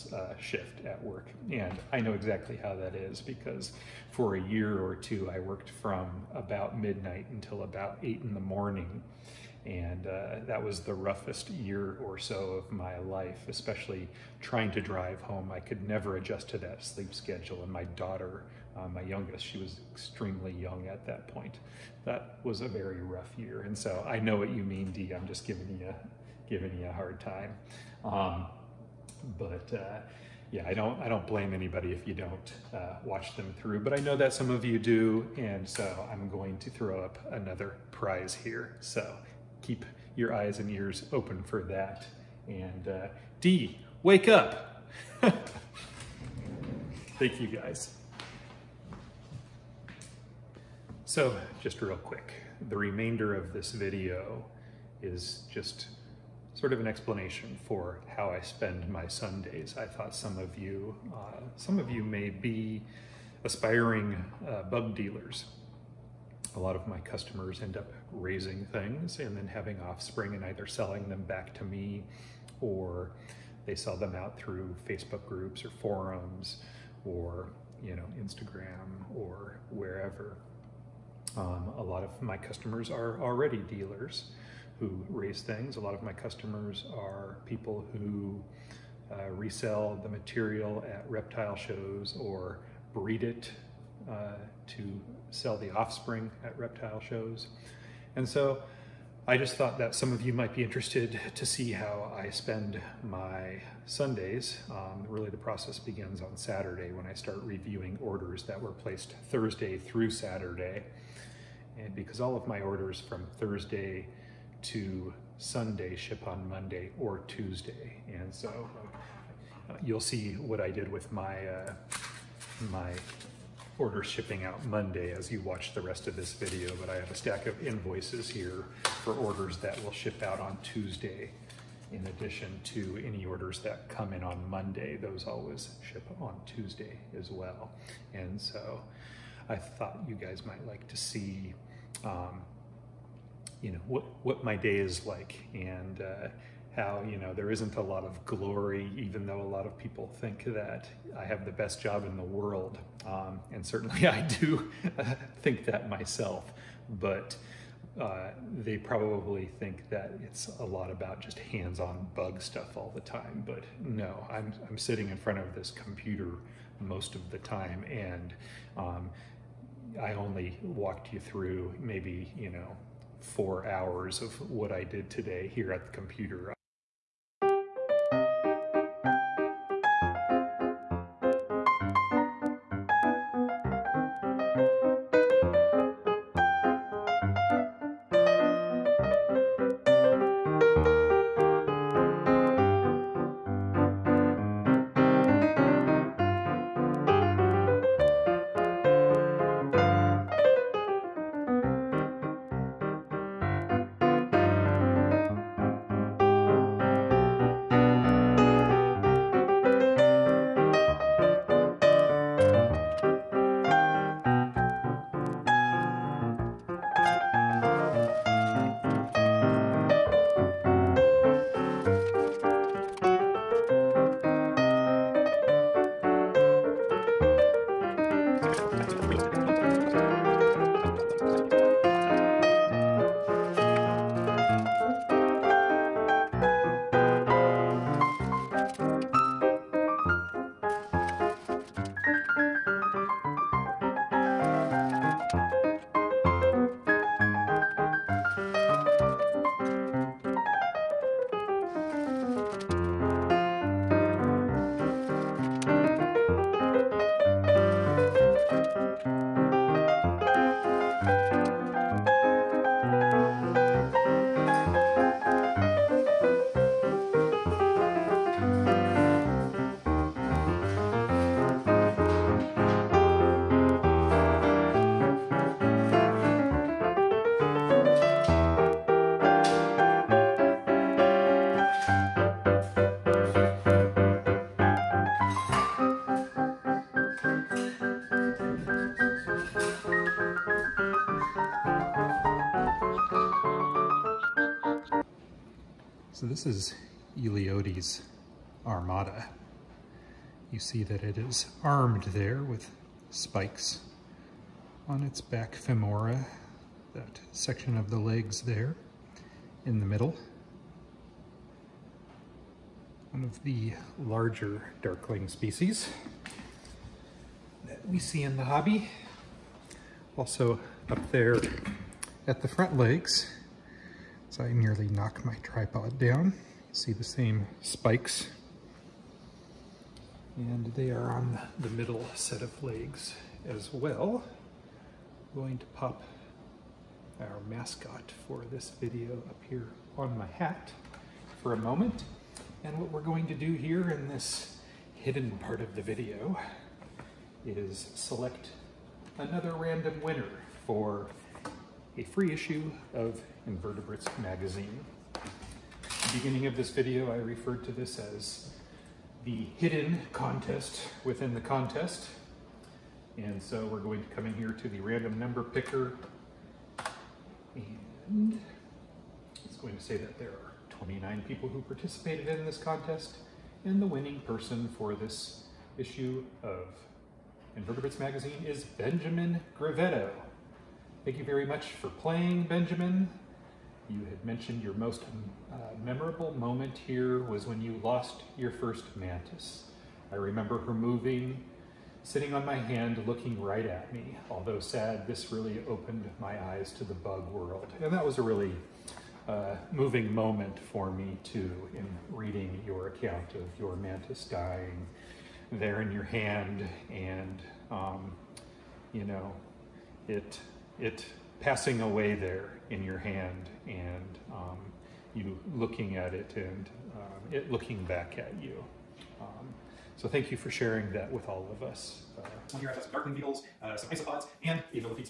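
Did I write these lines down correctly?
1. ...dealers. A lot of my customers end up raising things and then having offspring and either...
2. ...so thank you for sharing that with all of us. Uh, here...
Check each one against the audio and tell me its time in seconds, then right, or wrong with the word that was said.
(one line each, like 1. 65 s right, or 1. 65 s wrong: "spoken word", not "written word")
1. 64 s right
2. 419 s right.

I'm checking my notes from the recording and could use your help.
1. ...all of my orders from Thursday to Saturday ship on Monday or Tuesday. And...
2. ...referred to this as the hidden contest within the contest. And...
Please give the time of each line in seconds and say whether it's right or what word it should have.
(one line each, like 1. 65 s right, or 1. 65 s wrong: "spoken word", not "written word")
1. 112 s wrong: "Sunday", not "Saturday"
2. 357 s right.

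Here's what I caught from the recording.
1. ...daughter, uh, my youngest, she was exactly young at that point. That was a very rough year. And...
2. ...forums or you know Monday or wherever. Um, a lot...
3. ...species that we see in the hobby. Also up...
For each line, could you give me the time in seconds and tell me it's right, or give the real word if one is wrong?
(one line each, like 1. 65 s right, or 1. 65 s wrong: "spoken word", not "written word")
1. 17 s wrong: "extremely", not "exactly"
2. 75 s wrong: "Instagram", not "Monday"
3. 315 s right.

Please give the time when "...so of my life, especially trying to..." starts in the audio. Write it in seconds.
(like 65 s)
12 s.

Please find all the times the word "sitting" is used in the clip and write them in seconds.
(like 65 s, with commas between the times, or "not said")
164 s, 392 s.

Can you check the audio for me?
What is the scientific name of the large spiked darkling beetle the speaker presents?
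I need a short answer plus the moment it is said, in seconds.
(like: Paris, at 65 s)
Eleodes armata, at 297 s.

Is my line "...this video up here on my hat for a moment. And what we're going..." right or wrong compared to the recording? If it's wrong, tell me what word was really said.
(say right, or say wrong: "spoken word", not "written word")
right.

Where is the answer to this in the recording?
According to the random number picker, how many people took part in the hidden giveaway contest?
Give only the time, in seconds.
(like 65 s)
370 s.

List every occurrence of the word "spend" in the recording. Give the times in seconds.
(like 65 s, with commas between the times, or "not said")
58 s, 102 s.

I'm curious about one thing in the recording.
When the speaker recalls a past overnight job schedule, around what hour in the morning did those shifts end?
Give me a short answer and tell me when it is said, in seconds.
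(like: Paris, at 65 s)
8, at 8 s.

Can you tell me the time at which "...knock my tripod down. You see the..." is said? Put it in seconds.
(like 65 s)
324 s.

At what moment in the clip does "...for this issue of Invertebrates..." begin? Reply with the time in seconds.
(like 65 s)
374 s.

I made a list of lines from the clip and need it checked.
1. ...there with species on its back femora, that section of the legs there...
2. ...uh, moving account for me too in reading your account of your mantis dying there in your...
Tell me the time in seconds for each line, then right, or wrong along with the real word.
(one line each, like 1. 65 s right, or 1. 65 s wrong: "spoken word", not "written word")
1. 302 s wrong: "spikes", not "species"
2. 399 s wrong: "moment", not "account".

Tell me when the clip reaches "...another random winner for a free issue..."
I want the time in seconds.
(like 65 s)
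349 s.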